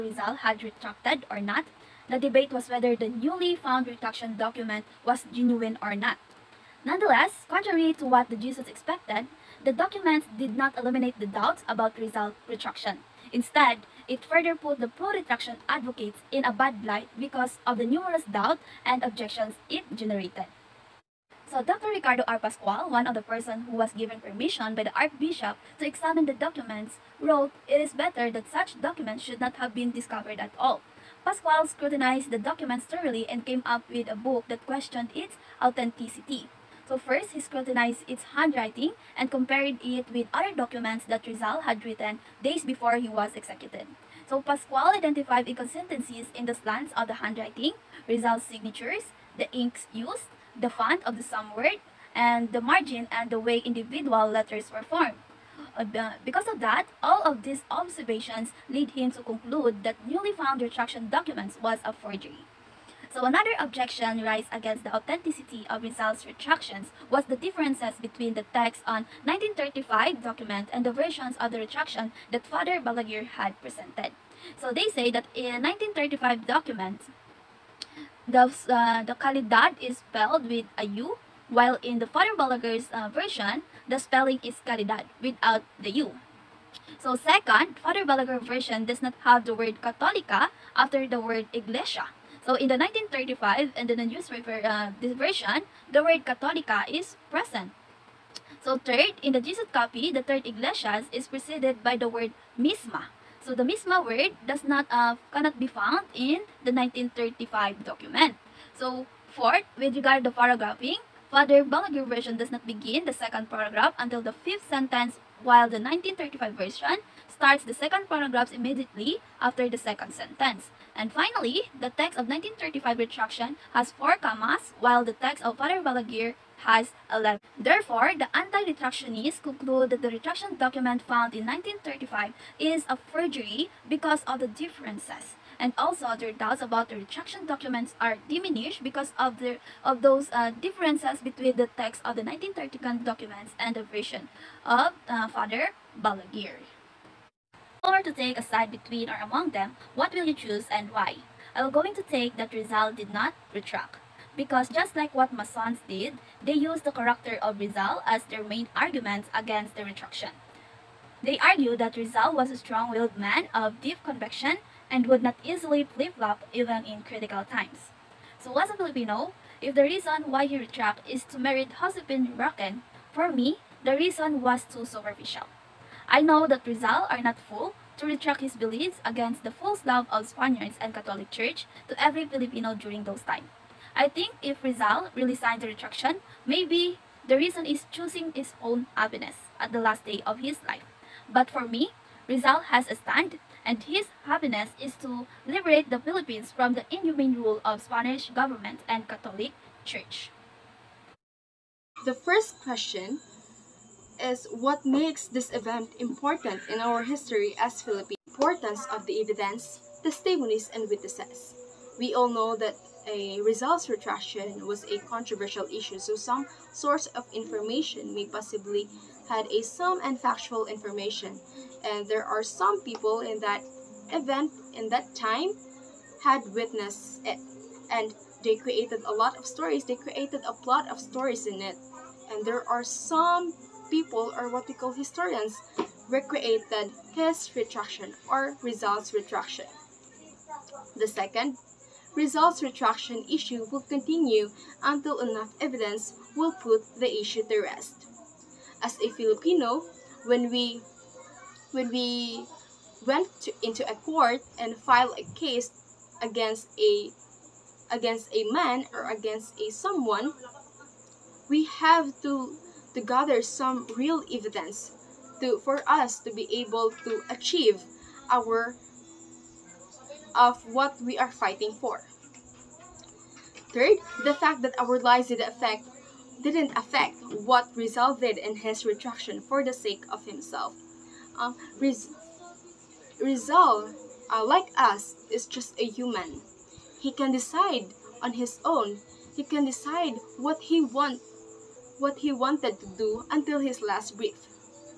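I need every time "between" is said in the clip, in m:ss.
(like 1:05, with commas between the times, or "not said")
1:07, 2:21, 2:28.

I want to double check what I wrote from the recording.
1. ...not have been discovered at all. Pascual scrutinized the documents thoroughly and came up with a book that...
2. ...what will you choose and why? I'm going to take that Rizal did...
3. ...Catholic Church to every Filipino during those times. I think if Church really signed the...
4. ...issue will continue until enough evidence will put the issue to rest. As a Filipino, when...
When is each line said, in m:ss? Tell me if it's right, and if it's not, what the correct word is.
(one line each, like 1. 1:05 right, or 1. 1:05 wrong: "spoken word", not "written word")
1. 0:29 right
2. 2:29 right
3. 3:00 wrong: "Rizal", not "Church"
4. 4:03 right.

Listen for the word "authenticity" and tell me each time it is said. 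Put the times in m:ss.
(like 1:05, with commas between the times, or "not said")
0:35, 1:04.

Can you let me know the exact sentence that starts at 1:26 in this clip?
So second, Father Balaguer version does not have the word Católica after the word Iglesia.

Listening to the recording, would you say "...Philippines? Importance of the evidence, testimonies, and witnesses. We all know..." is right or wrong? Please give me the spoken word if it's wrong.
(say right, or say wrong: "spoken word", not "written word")
right.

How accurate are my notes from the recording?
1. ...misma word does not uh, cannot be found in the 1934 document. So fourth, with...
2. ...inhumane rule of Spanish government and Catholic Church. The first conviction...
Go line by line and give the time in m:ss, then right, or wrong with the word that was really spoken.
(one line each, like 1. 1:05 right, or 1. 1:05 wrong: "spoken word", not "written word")
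1. 1:43 wrong: "1935", not "1934"
2. 3:16 wrong: "question", not "conviction".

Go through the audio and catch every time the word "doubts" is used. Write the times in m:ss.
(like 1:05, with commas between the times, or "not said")
0:11, 0:18, 2:16.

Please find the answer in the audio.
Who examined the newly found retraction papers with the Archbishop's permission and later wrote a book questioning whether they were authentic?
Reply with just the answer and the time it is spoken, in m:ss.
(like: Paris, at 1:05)
Ricardo R. Pascual, at 0:21.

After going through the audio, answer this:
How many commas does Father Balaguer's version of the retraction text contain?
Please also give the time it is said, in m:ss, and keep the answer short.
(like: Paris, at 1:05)
11, at 2:07.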